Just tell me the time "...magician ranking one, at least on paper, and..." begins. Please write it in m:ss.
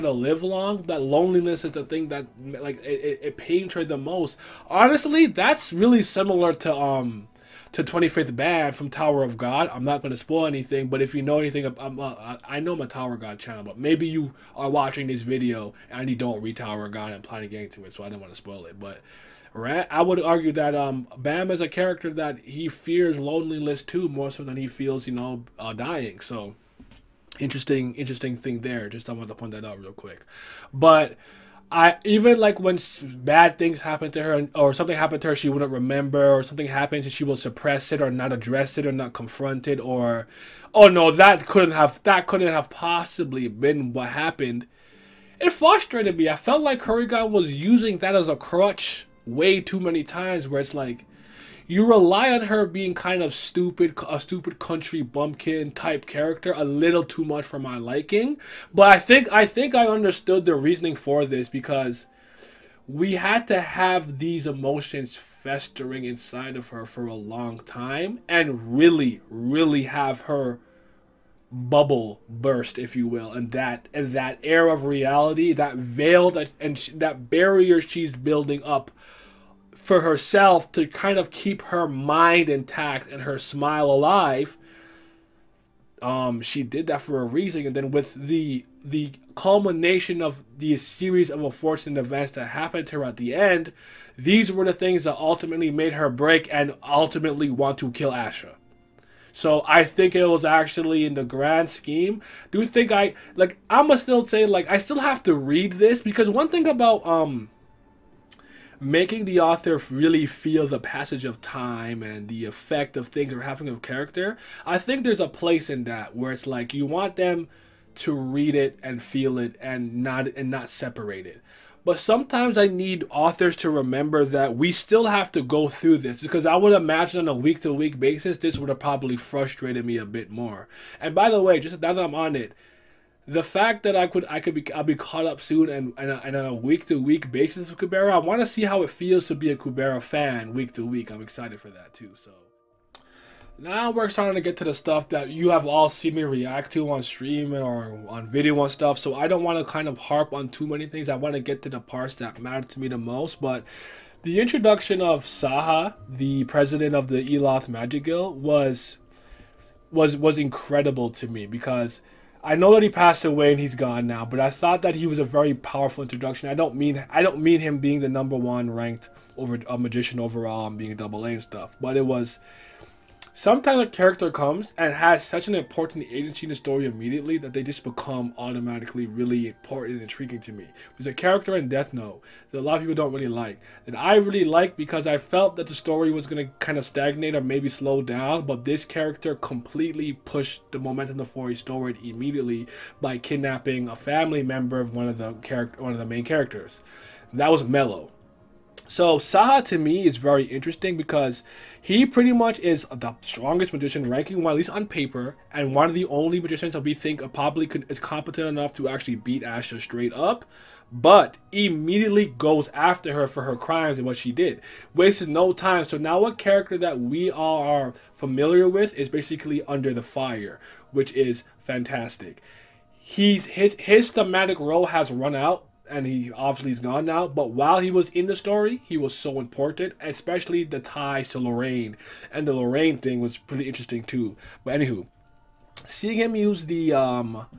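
3:23.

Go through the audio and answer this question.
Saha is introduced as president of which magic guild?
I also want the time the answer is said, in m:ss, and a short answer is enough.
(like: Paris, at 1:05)
Eloth Magic Guild, at 2:37.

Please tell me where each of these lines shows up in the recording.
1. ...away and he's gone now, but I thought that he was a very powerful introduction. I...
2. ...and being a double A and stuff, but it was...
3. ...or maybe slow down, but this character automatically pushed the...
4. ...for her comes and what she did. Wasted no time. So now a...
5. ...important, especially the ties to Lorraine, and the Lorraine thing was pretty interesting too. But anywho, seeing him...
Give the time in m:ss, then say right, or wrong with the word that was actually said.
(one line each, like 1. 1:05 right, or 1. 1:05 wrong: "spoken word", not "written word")
1. 2:43 right
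2. 2:50 right
3. 3:07 wrong: "completely", not "automatically"
4. 3:33 wrong: "crimes", not "comes"
5. 3:49 right.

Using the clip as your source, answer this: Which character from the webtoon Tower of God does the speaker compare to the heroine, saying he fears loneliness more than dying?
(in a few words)
25th Bam.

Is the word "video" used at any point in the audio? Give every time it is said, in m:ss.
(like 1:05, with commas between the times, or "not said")
0:15, 2:28.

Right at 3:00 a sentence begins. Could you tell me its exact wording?
There's a character in Death Note that a lot of people don't really like.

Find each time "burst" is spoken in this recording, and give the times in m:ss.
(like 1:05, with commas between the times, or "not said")
1:12.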